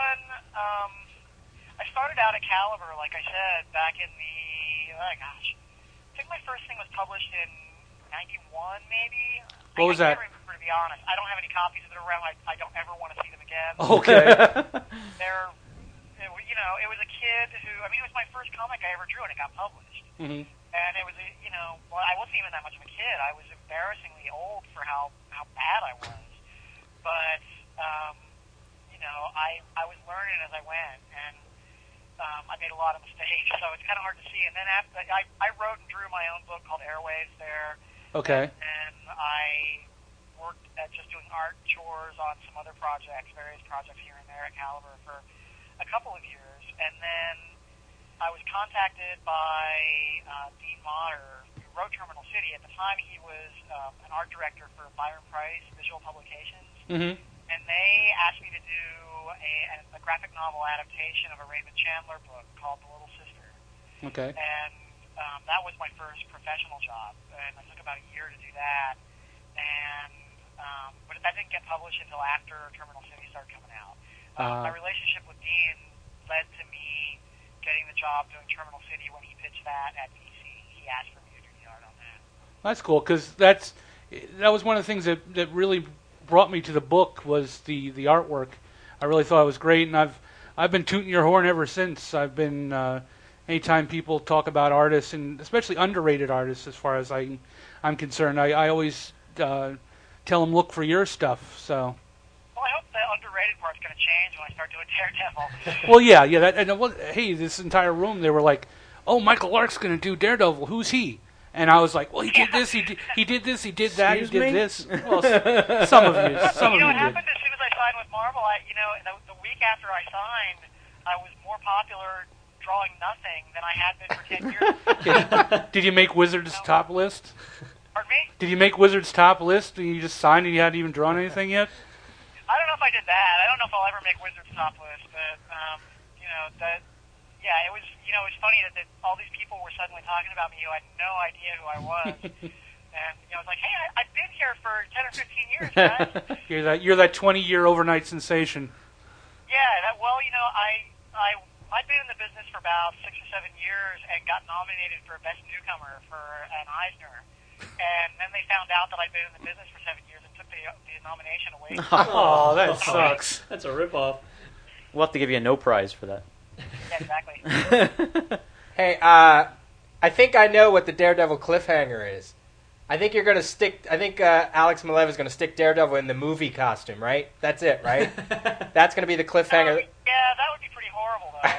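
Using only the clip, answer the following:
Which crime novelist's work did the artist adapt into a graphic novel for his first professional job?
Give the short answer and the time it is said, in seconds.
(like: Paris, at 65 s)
Raymond Chandler, at 61 s.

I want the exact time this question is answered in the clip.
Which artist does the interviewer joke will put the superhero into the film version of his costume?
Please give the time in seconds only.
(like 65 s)
174 s.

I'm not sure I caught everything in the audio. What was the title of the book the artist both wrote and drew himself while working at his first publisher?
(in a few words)
Airwaves.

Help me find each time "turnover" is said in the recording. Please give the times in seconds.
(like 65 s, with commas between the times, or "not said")
not said.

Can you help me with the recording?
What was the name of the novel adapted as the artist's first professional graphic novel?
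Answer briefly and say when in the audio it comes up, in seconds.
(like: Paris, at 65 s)
The Little Sister, at 62 s.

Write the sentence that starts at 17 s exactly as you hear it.
I mean, it was my first comic I ever drew, and it got published.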